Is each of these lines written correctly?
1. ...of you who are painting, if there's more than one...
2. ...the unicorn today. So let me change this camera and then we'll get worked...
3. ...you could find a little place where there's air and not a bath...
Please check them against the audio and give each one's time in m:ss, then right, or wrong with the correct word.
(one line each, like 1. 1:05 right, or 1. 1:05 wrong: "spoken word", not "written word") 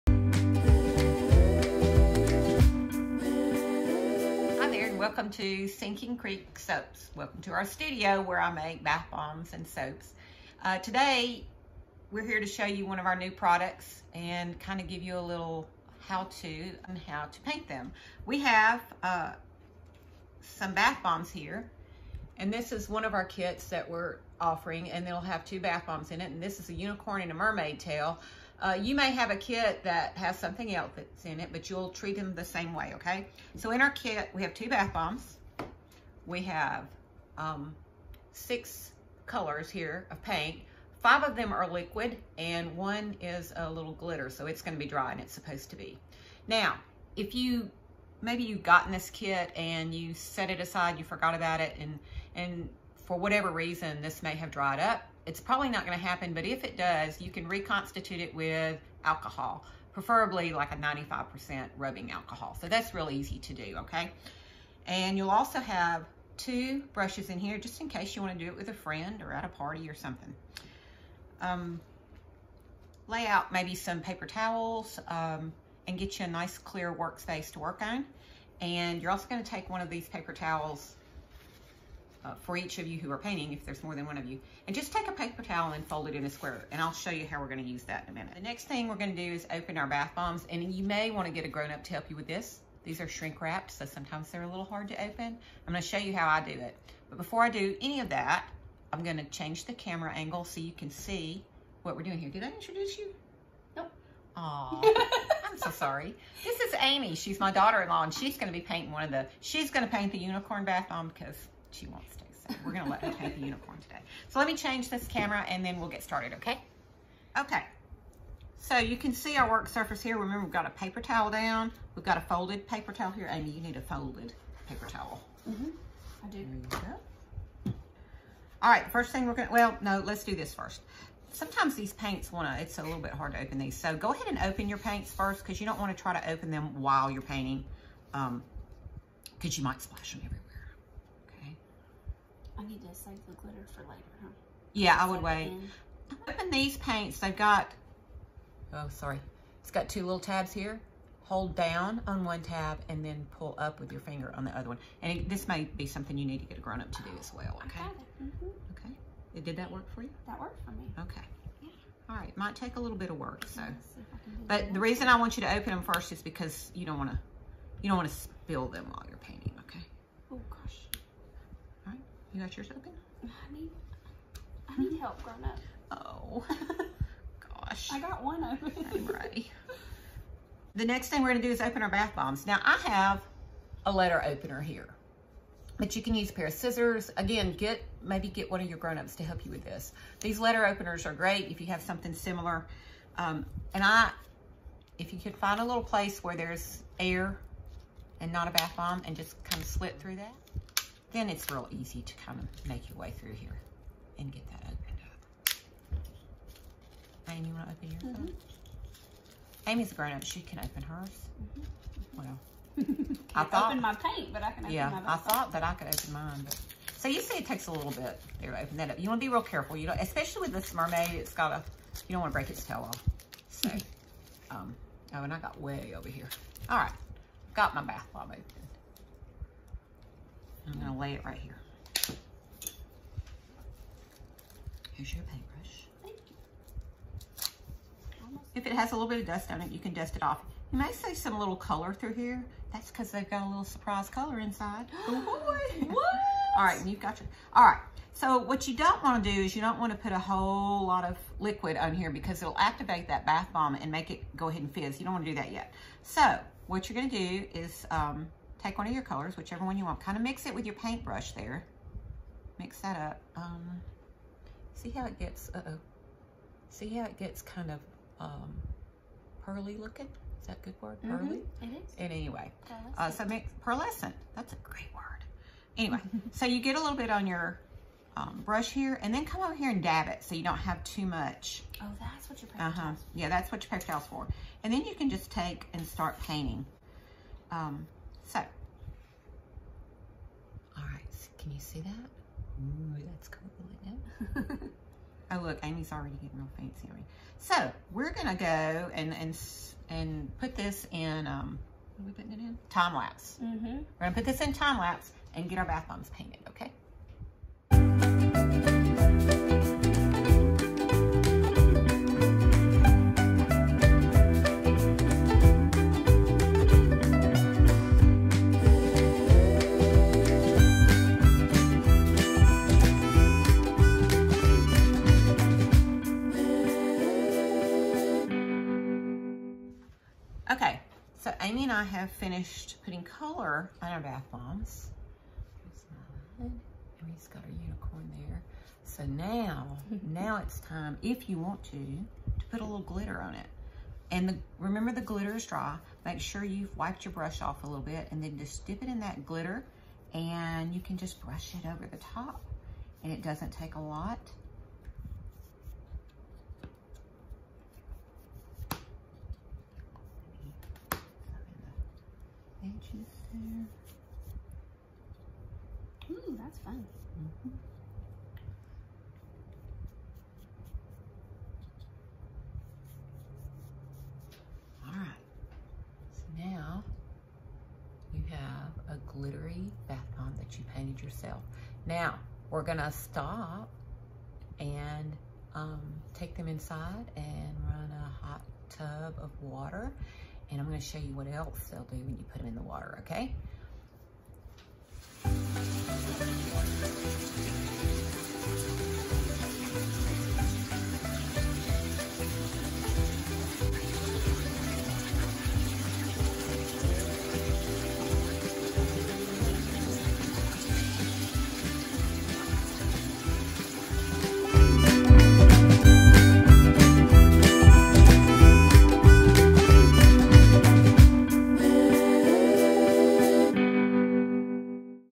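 1. 1:22 right
2. 1:53 wrong: "started", not "worked"
3. 3:15 right.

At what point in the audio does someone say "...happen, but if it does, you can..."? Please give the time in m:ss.
0:56.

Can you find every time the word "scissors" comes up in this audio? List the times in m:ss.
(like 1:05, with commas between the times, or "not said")
3:06.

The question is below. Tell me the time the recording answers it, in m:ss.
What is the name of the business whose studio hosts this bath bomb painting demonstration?
0:05.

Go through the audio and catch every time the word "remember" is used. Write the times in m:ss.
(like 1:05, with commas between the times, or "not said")
2:00, 5:44.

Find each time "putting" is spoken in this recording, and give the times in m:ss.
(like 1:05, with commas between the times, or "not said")
5:02, 5:32.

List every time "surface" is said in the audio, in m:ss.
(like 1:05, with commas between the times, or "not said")
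1:59.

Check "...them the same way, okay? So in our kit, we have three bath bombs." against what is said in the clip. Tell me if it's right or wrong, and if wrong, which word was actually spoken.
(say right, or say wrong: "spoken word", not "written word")
wrong: "two", not "three".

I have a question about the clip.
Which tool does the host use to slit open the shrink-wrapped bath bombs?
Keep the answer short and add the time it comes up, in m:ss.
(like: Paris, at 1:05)
letter opener, at 3:03.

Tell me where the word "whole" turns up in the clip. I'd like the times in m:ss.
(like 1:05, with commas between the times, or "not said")
4:10.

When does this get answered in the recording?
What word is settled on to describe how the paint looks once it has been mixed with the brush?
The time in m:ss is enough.
4:33.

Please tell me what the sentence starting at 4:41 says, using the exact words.
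Oh, that's what your paper uh -huh.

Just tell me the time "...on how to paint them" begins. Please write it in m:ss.
0:16.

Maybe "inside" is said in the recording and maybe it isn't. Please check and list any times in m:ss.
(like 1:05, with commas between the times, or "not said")
4:04, 6:26.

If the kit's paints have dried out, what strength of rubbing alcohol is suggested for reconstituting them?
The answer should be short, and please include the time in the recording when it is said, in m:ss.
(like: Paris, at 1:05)
95%, at 1:00.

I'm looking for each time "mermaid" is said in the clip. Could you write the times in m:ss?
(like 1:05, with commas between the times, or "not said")
0:27, 3:40.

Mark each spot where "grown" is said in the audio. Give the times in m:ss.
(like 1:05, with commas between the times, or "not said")
1:31, 2:36, 2:55, 3:08, 3:29.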